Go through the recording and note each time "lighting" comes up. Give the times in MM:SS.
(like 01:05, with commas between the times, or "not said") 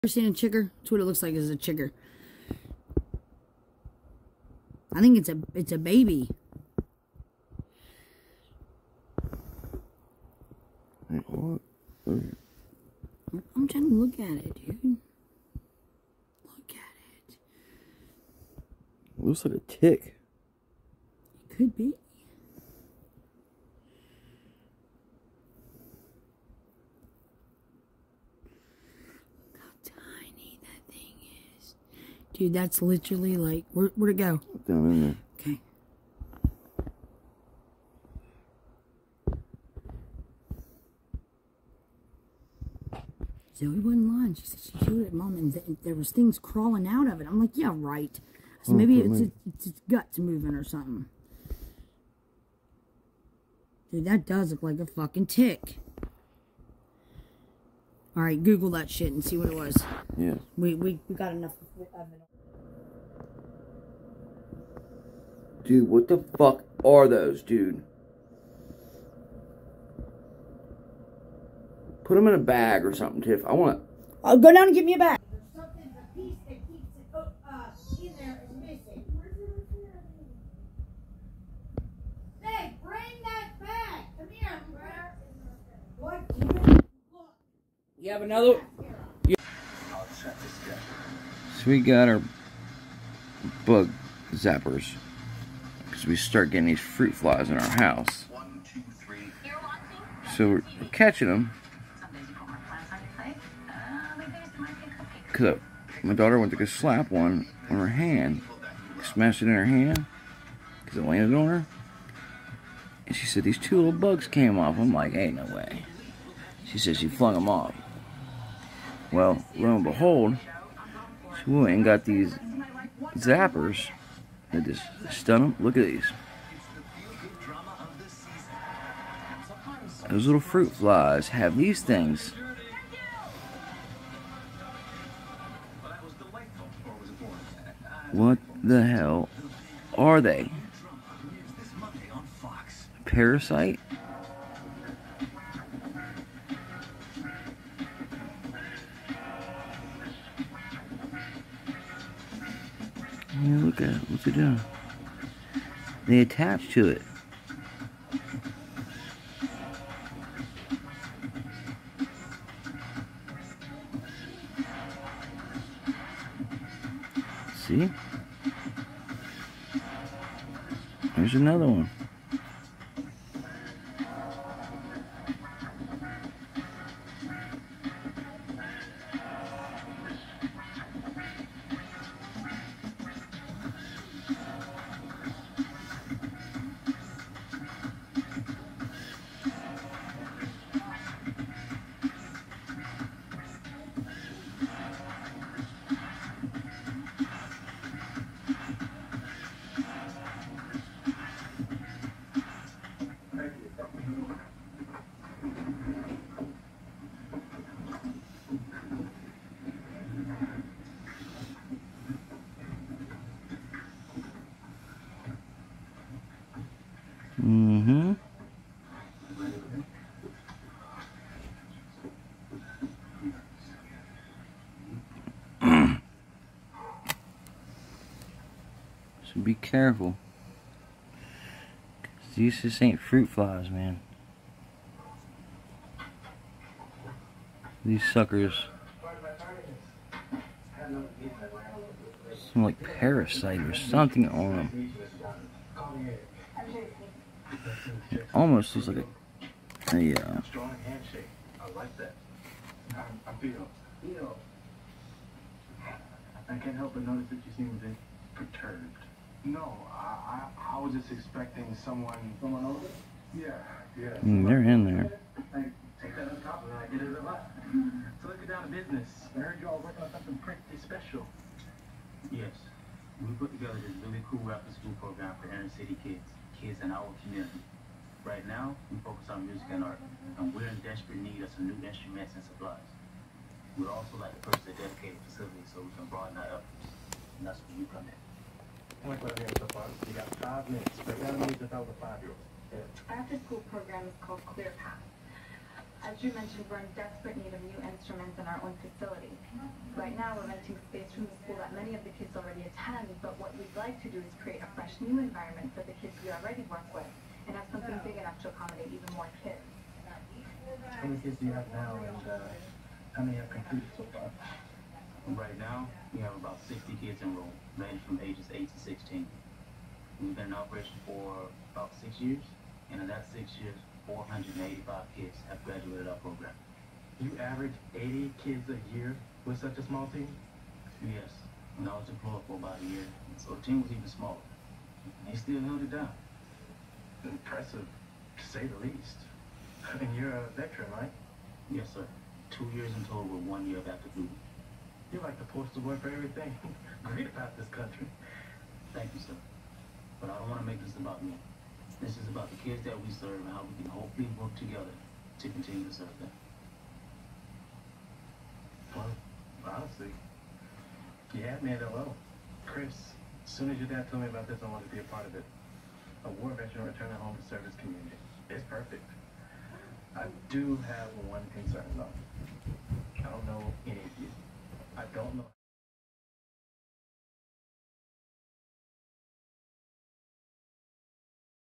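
not said.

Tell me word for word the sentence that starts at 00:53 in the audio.
Dude, that does look like a fucking tick.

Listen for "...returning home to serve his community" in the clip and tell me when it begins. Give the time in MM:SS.
06:06.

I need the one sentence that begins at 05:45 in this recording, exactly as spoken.
You're like the postal boy for everything.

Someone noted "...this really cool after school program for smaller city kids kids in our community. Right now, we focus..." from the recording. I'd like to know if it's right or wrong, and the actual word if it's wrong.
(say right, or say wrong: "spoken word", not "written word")
wrong: "inner", not "smaller".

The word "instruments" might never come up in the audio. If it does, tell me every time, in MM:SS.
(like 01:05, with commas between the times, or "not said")
04:41, 04:57.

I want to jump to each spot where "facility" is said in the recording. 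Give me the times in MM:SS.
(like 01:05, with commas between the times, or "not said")
04:45, 04:58.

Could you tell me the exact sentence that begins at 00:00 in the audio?
That's what it looks like is a chigger.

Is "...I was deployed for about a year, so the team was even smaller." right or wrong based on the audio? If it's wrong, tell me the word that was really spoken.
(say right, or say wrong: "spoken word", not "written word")
right.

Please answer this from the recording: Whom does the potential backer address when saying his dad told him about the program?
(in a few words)
Chris.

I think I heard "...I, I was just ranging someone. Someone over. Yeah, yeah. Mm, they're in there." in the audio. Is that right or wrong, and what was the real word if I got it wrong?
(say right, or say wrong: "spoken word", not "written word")
wrong: "expecting", not "ranging".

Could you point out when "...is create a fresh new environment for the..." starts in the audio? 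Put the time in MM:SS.
05:04.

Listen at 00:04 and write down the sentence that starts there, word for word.
I think it's a it's a baby.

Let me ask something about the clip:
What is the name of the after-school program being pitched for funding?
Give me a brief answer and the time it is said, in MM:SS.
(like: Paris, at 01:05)
Clear Path, at 04:54.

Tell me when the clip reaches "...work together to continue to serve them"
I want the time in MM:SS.
05:54.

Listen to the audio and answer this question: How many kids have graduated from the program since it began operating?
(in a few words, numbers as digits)
485.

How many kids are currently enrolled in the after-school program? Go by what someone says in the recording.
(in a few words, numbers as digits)
60.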